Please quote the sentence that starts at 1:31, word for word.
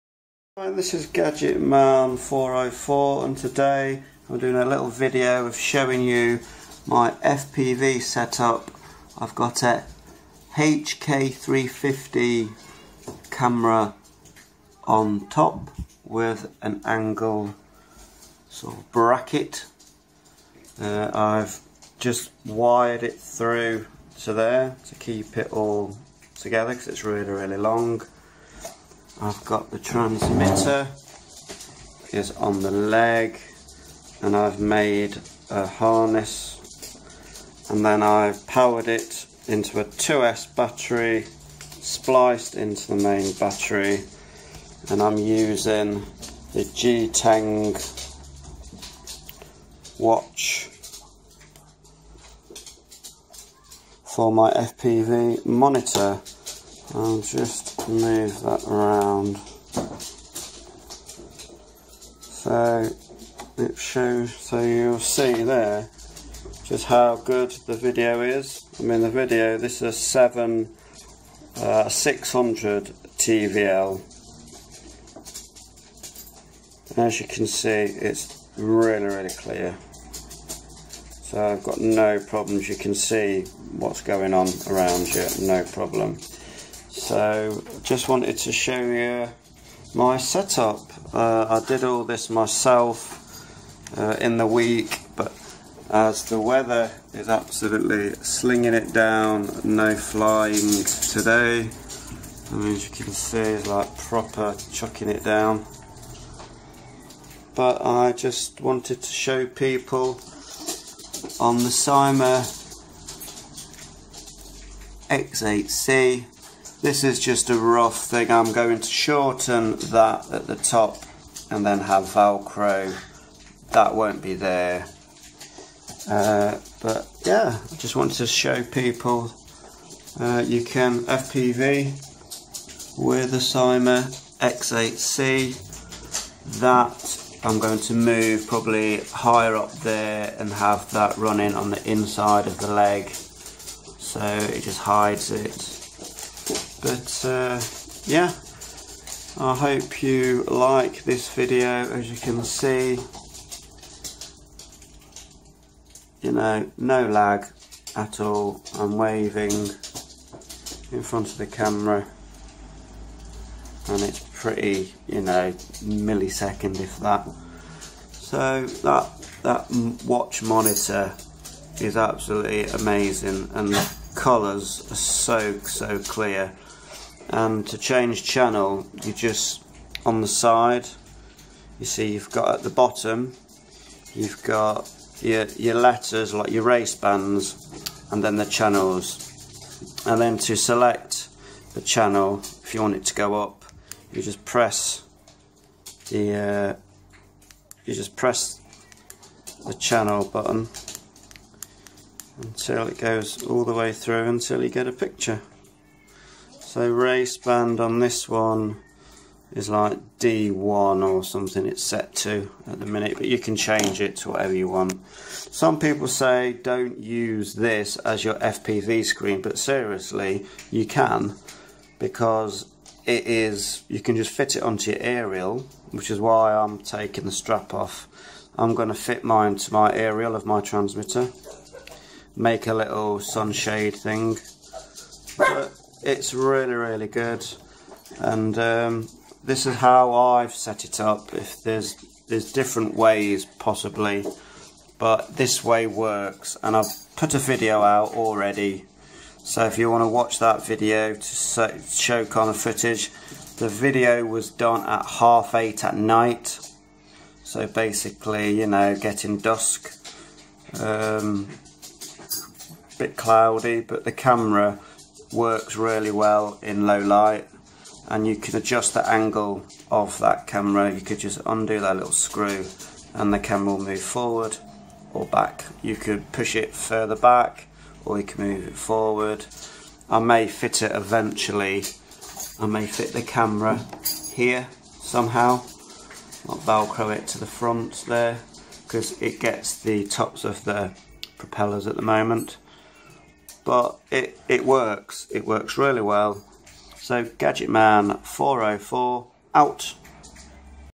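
Uh, I did all this myself uh, in the week, but as the weather is absolutely slinging it down, no flying today.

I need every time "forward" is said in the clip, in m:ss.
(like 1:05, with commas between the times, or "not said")
4:34, 4:38.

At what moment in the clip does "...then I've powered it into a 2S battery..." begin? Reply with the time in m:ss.
0:37.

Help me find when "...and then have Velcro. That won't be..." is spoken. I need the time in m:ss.
2:01.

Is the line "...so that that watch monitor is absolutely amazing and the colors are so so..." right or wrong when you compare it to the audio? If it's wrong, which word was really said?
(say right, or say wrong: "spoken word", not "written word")
right.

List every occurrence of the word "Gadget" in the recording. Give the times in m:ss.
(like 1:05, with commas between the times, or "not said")
0:01, 4:57.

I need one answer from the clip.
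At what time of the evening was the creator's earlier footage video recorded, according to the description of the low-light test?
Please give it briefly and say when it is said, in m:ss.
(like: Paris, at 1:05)
8:30, at 4:15.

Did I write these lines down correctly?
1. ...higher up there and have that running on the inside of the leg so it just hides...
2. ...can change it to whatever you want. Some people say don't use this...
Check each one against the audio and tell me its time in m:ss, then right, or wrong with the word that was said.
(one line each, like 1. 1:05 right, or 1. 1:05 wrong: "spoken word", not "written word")
1. 2:19 right
2. 3:33 right.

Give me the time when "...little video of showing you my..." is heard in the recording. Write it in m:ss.
0:04.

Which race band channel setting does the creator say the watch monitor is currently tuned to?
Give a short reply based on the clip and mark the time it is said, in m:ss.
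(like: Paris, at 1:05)
D1, at 3:30.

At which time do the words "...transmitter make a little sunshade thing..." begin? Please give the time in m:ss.
3:50.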